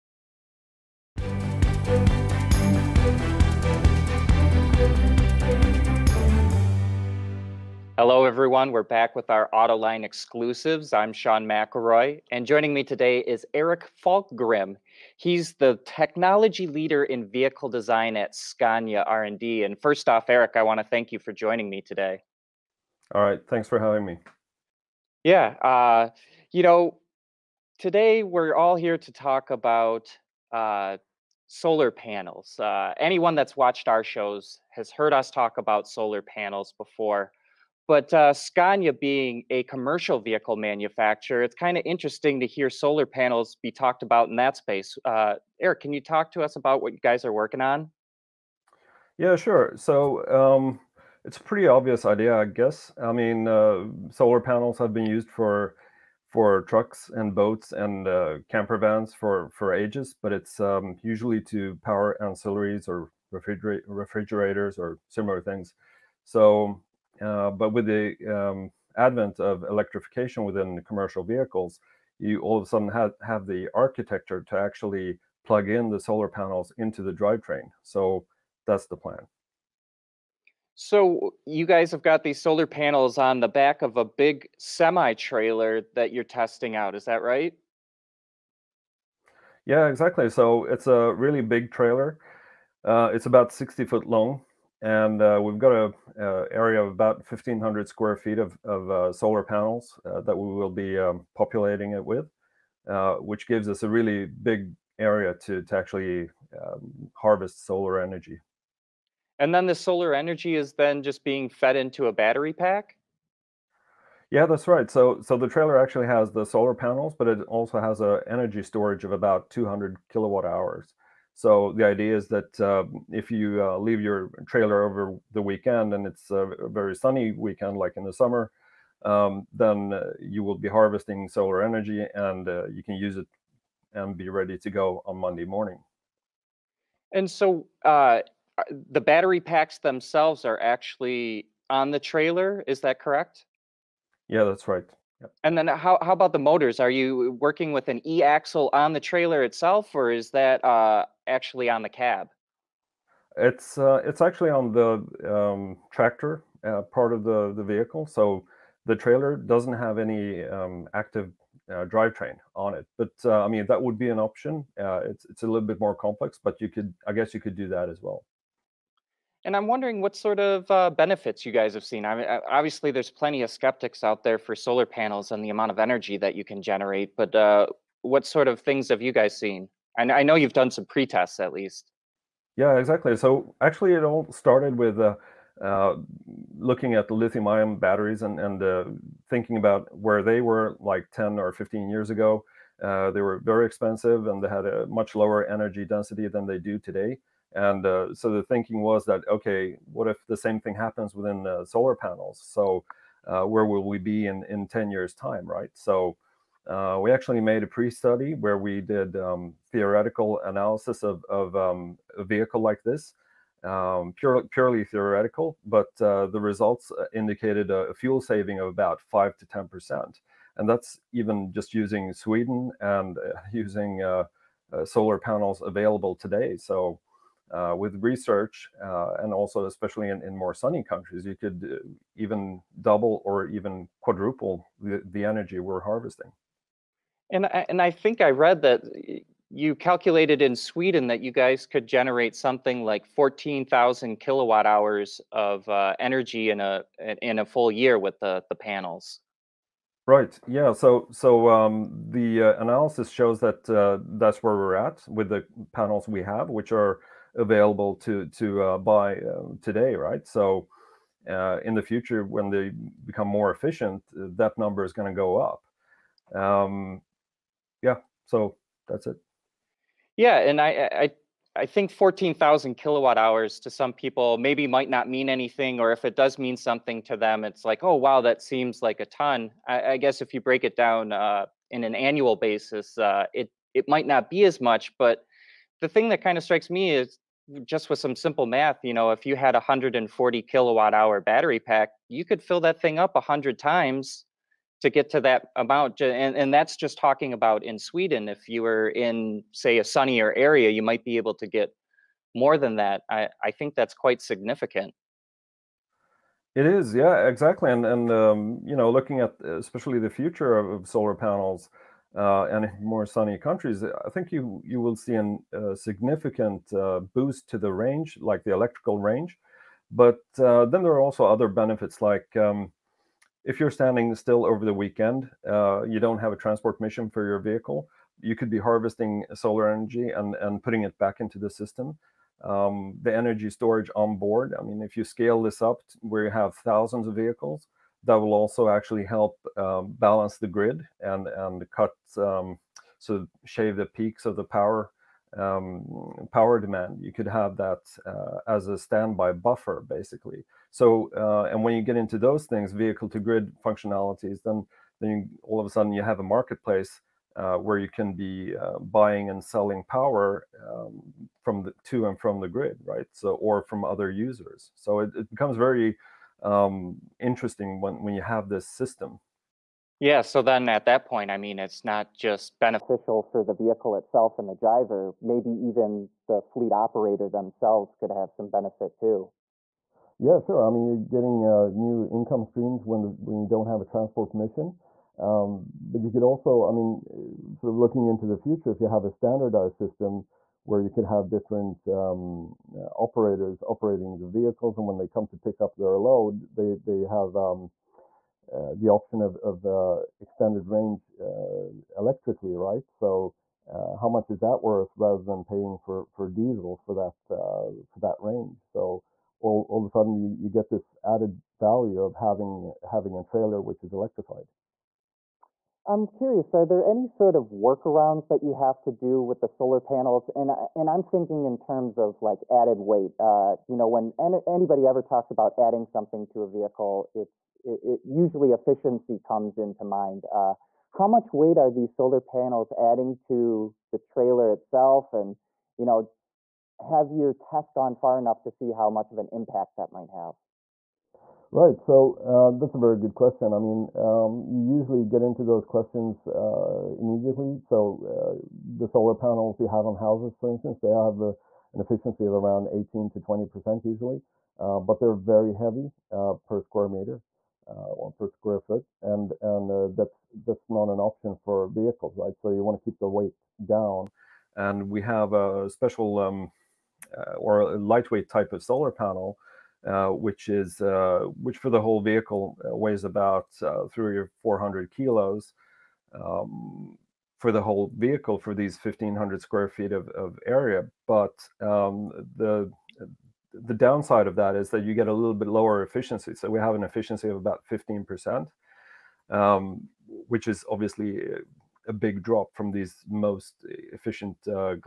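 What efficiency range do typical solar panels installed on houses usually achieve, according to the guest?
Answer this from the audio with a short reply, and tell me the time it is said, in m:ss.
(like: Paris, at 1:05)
18 to 20 percent, at 7:32.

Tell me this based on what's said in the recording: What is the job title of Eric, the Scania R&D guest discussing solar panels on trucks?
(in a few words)
Technology leader in vehicle design.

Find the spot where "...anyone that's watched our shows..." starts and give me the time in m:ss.
0:32.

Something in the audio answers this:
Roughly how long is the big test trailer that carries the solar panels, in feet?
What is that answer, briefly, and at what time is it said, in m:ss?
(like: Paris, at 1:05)
60 foot, at 1:33.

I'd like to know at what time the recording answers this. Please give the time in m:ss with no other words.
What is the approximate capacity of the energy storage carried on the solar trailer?
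1:59.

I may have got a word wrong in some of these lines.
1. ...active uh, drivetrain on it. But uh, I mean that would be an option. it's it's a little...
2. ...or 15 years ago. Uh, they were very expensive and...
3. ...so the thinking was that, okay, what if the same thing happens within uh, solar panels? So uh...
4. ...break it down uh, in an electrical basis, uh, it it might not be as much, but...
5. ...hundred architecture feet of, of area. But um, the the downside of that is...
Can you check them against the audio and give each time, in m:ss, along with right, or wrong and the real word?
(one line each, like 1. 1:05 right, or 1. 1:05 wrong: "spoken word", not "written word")
1. 2:40 right
2. 3:11 right
3. 3:18 right
4. 4:40 wrong: "annual", not "electrical"
5. 7:59 wrong: "square", not "architecture".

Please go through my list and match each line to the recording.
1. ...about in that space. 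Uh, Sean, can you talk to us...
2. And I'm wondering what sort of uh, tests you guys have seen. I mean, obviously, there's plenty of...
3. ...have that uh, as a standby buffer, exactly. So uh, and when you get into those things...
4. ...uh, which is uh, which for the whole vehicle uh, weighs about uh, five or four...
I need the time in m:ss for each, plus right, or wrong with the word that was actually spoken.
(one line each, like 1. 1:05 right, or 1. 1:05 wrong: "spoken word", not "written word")
1. 0:44 wrong: "Eric", not "Sean"
2. 2:49 wrong: "benefits", not "tests"
3. 5:47 wrong: "basically", not "exactly"
4. 7:49 wrong: "three", not "five".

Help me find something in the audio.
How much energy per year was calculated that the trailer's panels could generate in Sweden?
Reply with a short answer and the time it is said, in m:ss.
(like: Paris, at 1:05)
14000 kilowatt hours, at 4:03.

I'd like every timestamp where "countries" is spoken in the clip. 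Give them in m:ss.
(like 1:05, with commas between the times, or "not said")
3:50, 5:13.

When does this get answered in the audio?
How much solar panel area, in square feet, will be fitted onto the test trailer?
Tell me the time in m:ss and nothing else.
1:37.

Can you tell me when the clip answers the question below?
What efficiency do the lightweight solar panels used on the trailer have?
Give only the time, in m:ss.
8:07.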